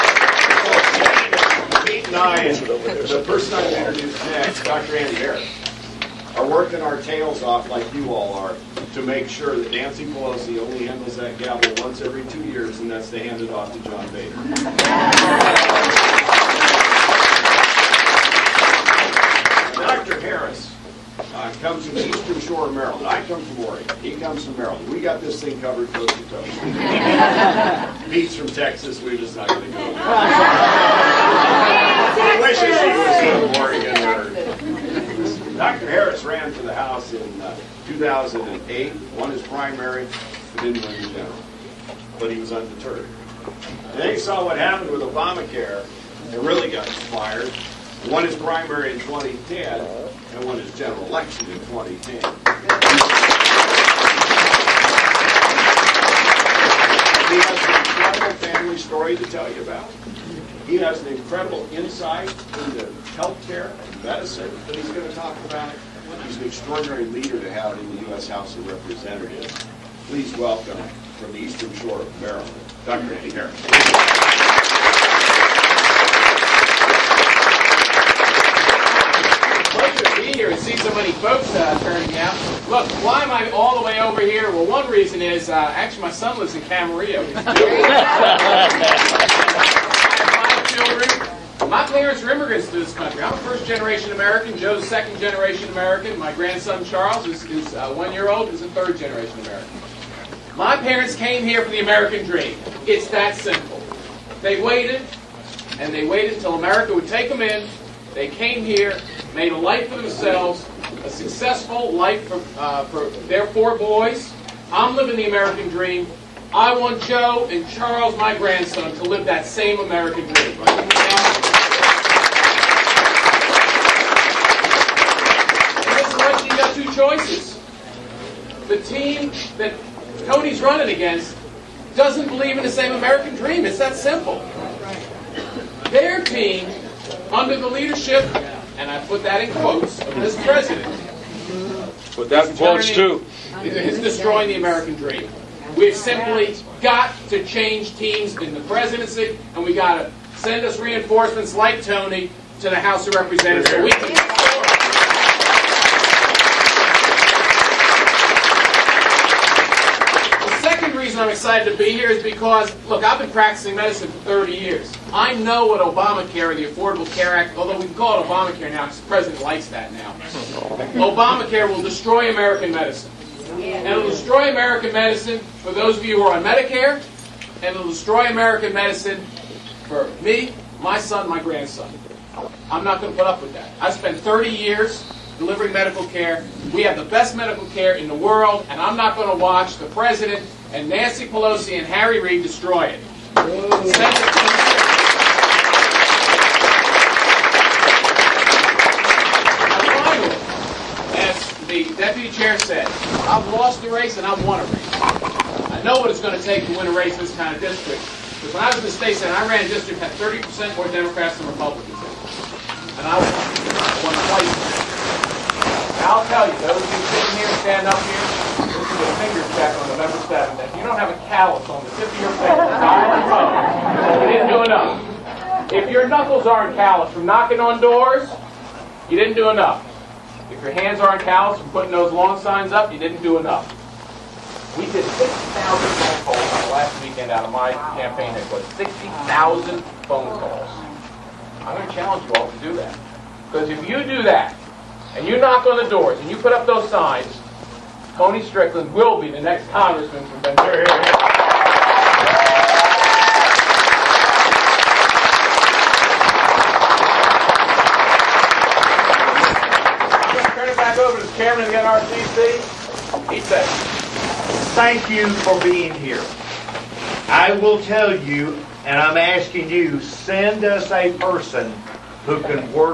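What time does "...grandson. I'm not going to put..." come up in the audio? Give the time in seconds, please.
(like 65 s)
181 s.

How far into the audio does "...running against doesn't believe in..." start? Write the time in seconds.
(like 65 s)
130 s.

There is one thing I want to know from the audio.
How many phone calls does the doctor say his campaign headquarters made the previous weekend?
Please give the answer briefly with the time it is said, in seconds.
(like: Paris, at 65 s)
60,000, at 235 s.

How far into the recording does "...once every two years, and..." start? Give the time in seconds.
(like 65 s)
11 s.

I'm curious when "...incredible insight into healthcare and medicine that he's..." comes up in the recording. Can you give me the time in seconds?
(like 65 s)
61 s.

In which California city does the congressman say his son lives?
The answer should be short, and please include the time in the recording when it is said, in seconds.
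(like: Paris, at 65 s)
Camarillo, at 86 s.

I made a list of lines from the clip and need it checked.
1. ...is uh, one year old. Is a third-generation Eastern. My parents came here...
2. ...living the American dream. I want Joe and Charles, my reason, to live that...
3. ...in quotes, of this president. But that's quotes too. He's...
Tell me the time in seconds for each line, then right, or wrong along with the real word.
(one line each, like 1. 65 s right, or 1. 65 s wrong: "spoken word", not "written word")
1. 97 s wrong: "American", not "Eastern"
2. 114 s wrong: "grandson", not "reason"
3. 139 s right.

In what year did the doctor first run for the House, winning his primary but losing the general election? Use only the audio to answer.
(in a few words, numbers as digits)
2008.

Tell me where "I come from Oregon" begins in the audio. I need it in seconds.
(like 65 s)
23 s.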